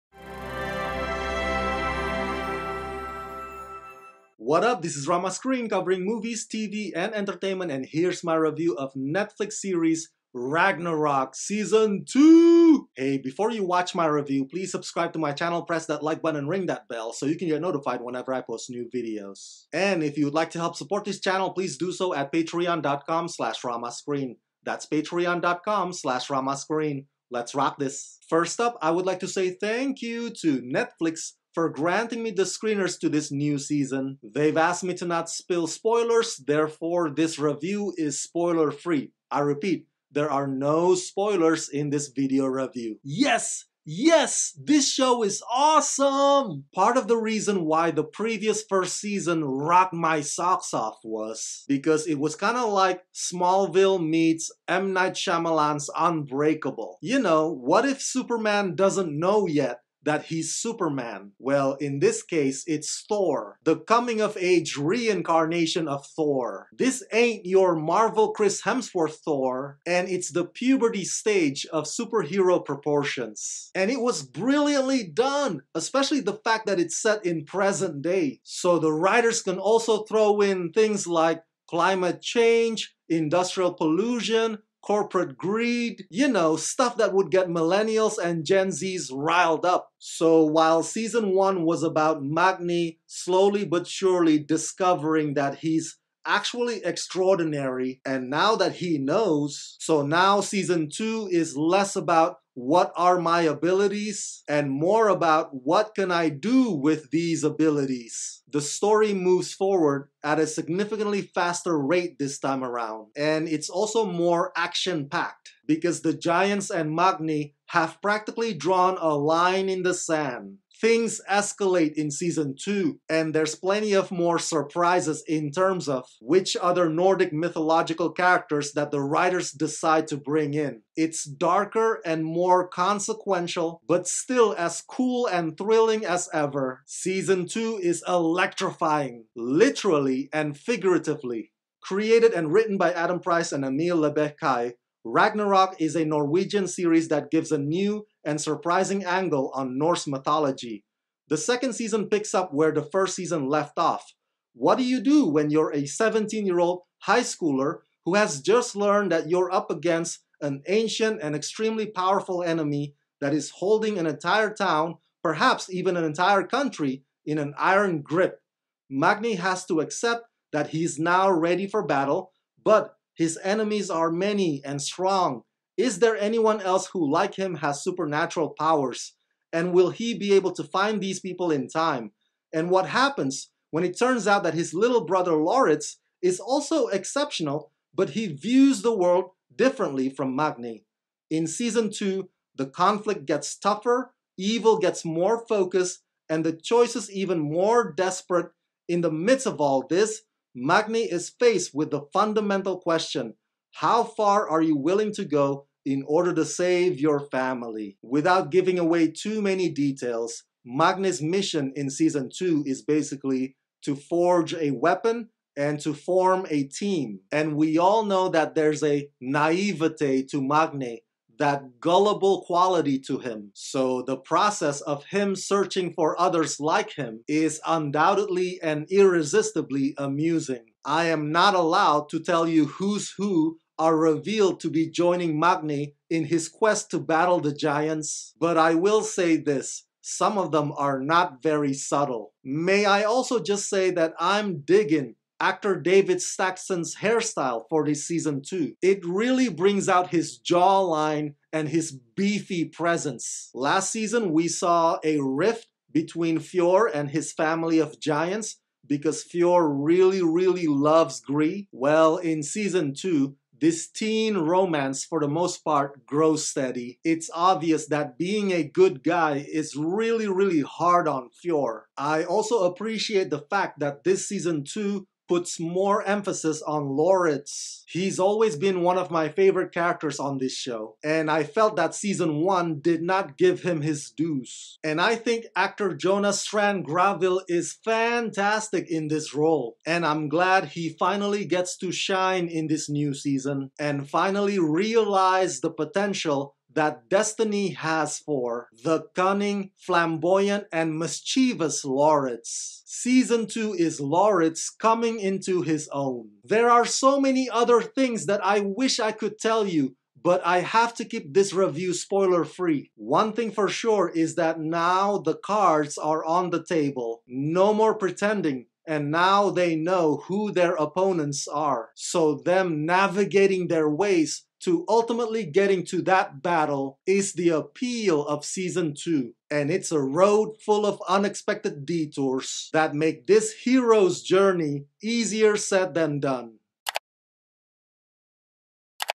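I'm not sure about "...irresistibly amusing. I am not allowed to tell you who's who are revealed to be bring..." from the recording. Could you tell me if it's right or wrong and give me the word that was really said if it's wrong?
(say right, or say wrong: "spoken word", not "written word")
wrong: "joining", not "bring".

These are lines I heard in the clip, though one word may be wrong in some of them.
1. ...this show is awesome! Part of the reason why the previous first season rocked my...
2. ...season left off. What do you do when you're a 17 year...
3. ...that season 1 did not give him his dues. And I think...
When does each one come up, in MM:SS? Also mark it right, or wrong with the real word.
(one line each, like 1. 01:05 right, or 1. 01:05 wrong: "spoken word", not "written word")
1. 00:44 right
2. 02:33 right
3. 04:41 right.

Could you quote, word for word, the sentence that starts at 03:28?
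Without giving away too many details, Magnus' mission in season two is basically to forge a weapon and to form a team.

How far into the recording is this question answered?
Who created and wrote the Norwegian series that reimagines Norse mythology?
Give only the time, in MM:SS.
02:22.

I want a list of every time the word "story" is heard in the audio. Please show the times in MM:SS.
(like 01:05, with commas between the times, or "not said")
01:48.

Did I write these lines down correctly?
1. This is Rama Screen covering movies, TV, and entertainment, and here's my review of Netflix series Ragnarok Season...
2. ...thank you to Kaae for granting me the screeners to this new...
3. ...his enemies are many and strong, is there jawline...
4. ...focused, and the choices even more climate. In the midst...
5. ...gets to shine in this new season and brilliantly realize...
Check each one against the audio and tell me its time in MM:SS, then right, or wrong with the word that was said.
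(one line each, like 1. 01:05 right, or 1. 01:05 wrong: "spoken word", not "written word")
1. 00:04 right
2. 00:29 wrong: "Netflix", not "Kaae"
3. 02:53 wrong: "anyone", not "jawline"
4. 03:15 wrong: "desperate", not "climate"
5. 04:51 wrong: "finally", not "brilliantly".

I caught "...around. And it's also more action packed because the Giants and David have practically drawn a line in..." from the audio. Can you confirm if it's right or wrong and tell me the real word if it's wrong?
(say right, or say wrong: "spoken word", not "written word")
wrong: "Magne", not "David".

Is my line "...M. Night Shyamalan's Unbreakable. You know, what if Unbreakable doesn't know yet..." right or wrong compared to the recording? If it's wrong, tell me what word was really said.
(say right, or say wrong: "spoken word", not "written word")
wrong: "Superman", not "Unbreakable".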